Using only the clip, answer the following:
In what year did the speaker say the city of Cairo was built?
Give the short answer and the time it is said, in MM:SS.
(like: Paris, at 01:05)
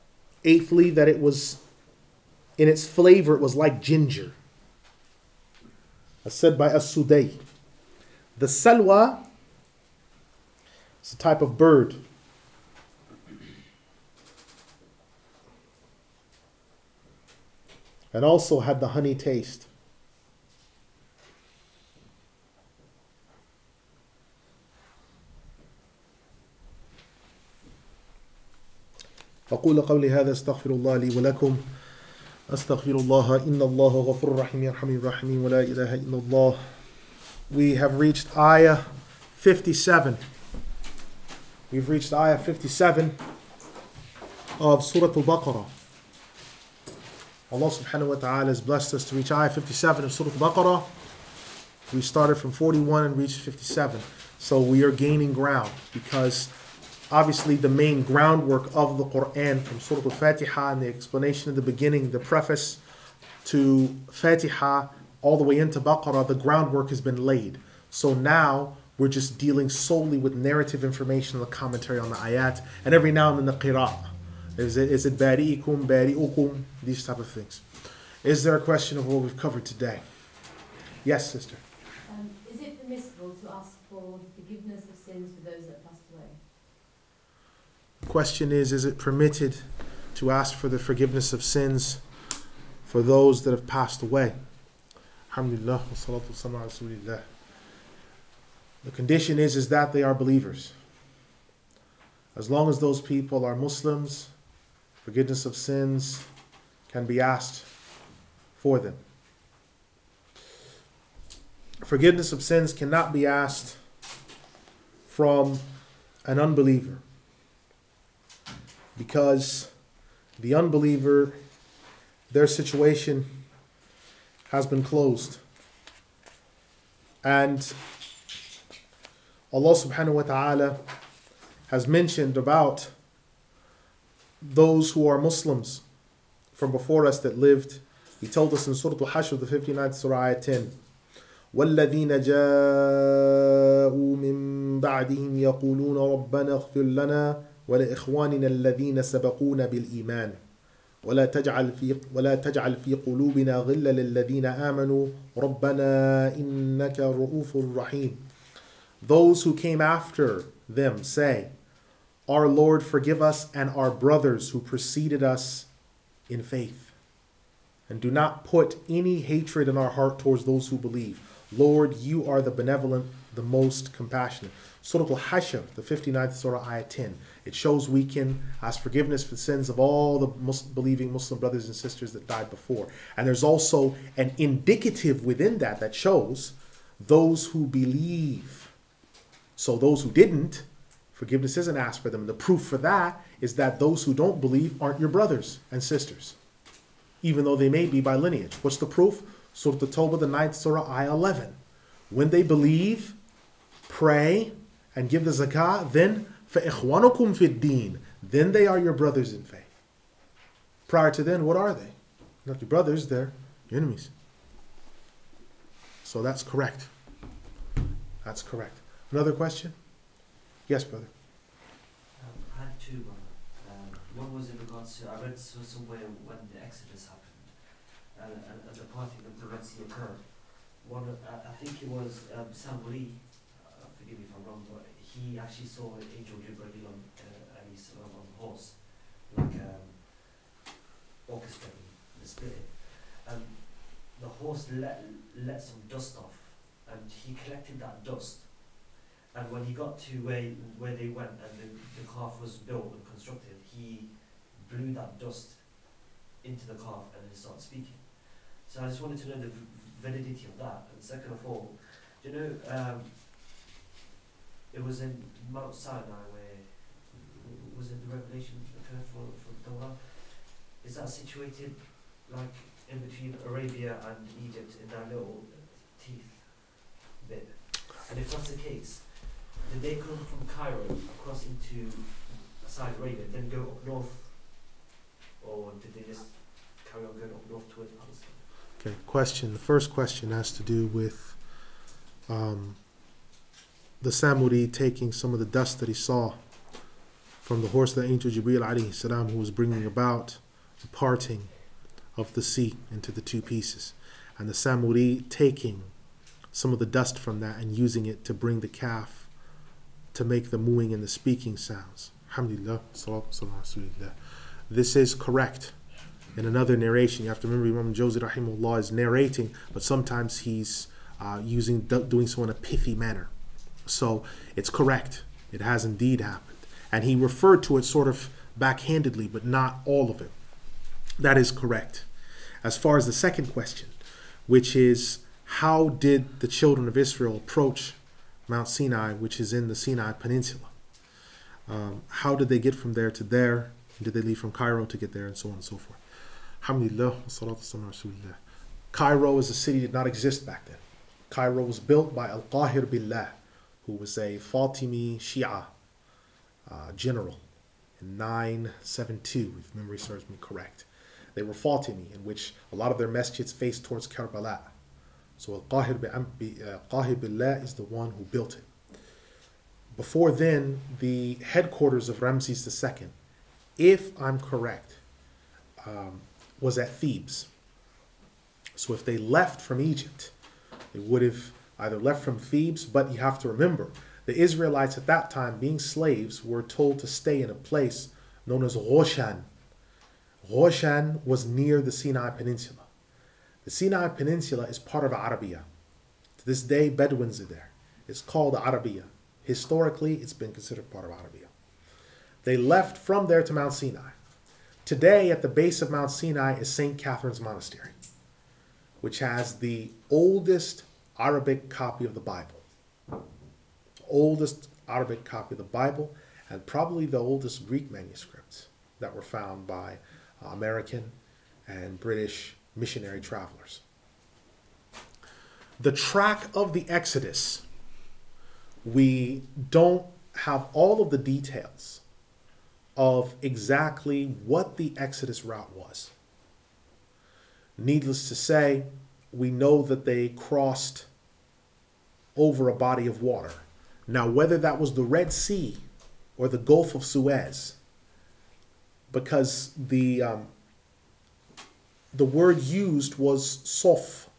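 972, at 05:58.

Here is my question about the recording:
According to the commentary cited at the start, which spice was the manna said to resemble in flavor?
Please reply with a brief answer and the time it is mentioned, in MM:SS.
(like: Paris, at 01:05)
ginger, at 00:03.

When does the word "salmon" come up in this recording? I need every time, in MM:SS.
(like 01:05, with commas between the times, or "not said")
not said.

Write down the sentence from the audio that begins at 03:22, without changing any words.
When they believe, pray, and give the zakah, then فَإِخْوَانُكُمْ فِي الدِّينِ Then they are your brothers in faith.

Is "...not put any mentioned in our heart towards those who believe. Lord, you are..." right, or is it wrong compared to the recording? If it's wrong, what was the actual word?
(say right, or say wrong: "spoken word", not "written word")
wrong: "hatred", not "mentioned".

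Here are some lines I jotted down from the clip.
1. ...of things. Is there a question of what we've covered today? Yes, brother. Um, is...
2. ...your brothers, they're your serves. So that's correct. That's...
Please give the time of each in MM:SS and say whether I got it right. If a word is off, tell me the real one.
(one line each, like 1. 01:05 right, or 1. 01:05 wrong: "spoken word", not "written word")
1. 01:17 wrong: "sister", not "brother"
2. 03:32 wrong: "enemies", not "serves".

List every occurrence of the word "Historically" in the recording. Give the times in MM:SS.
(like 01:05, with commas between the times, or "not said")
06:39.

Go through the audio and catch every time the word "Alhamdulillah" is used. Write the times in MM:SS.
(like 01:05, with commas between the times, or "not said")
01:35, 05:12.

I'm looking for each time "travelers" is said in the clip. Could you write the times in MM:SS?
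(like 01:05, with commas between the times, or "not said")
07:03.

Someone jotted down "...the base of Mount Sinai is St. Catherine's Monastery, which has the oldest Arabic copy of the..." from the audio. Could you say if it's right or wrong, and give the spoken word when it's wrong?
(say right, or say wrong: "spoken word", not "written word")
right.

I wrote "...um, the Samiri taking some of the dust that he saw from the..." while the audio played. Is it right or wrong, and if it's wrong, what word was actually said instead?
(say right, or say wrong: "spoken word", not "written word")
right.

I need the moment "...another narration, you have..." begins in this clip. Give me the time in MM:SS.
05:16.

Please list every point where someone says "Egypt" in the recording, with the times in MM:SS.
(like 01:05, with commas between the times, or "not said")
04:34, 06:19.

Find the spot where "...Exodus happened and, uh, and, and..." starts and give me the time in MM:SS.
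03:46.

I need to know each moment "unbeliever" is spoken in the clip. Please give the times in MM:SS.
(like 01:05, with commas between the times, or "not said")
01:56, 02:00.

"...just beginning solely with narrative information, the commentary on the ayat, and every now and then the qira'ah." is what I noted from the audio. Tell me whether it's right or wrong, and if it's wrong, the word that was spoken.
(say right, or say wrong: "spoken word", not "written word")
wrong: "dealing", not "beginning".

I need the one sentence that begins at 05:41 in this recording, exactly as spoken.
Um, how did they get from there to there?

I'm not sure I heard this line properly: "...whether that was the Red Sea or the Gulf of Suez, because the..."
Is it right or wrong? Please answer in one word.
right.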